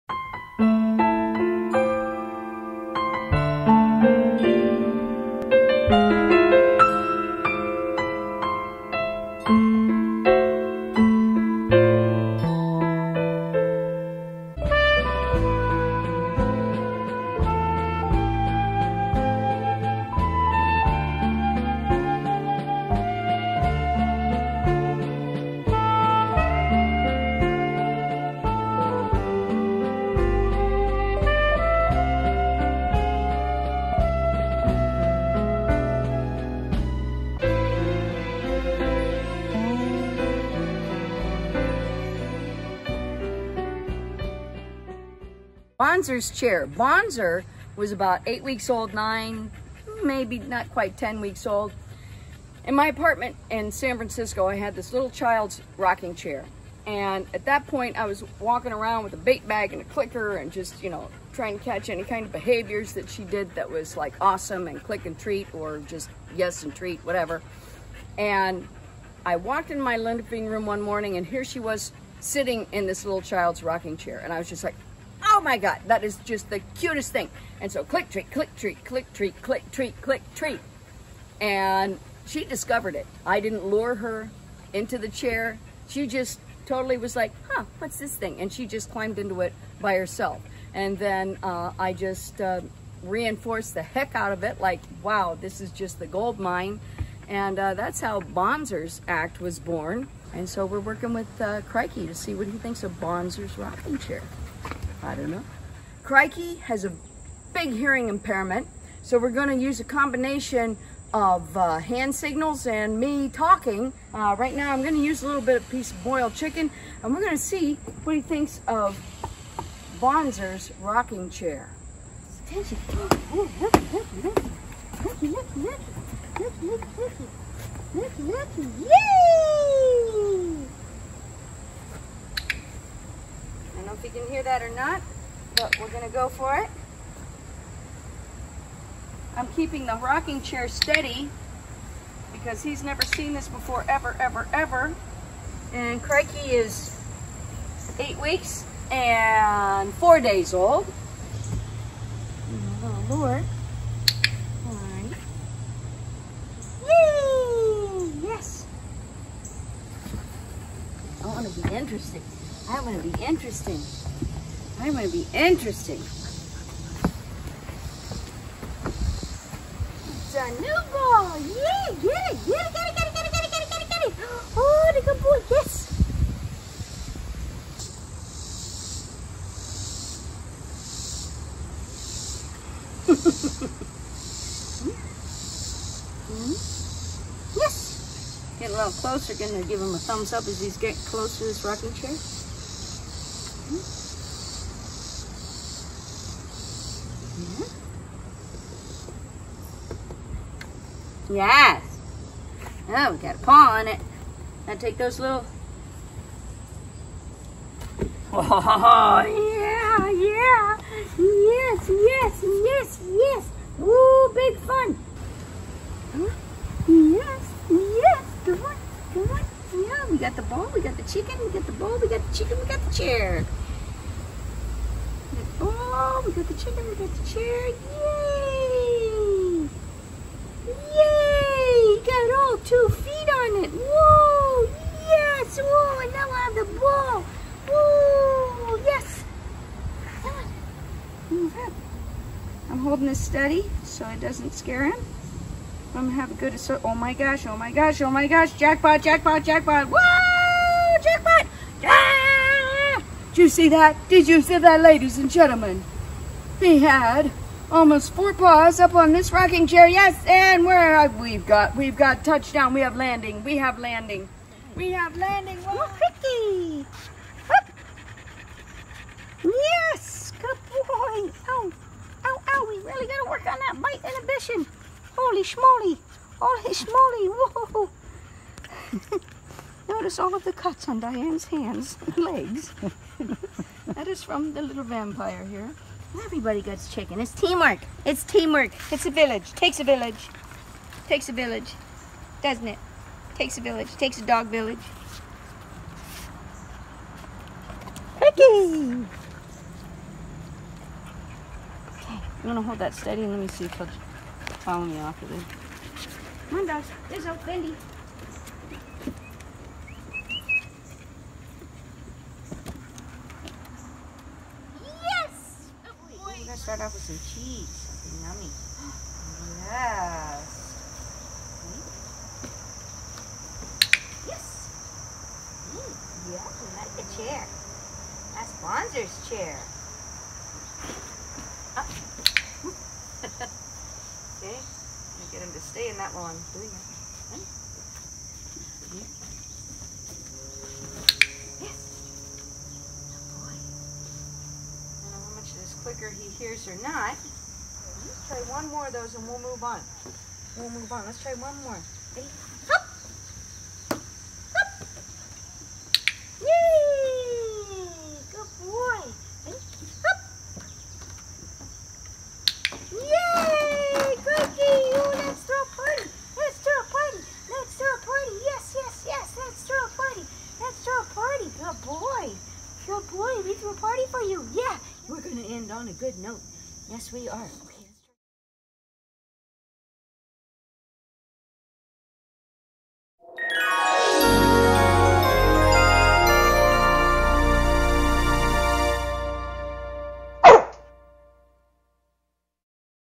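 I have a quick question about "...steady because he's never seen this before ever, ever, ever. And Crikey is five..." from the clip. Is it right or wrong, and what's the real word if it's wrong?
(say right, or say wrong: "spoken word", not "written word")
wrong: "eight", not "five".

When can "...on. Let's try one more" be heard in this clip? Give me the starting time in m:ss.
5:50.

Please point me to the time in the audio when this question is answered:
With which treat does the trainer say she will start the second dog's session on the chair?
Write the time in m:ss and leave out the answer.
5:17.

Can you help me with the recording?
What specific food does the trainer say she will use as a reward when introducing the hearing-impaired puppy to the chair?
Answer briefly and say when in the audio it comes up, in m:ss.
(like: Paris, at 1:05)
boiled chicken, at 1:56.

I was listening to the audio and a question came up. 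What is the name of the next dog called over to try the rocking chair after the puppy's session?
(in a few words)
Bendy.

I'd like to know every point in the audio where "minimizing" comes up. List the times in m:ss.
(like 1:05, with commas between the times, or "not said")
not said.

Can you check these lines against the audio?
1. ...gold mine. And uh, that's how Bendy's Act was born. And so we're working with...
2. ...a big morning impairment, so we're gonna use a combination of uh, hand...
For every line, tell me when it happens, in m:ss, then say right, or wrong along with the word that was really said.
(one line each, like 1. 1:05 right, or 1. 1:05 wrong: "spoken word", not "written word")
1. 1:36 wrong: "Bonzer", not "Bendy"
2. 1:46 wrong: "hearing", not "morning".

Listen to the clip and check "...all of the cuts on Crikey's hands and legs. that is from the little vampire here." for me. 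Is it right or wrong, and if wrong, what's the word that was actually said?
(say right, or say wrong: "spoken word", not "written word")
wrong: "Diane", not "Crikey".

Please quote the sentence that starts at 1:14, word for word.
And I was just like, oh my God, that is just the cutest thing.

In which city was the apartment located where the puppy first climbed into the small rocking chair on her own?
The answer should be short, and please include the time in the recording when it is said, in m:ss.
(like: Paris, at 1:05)
San Francisco, at 0:53.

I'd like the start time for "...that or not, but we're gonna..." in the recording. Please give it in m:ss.
2:14.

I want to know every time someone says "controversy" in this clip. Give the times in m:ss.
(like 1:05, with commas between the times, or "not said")
not said.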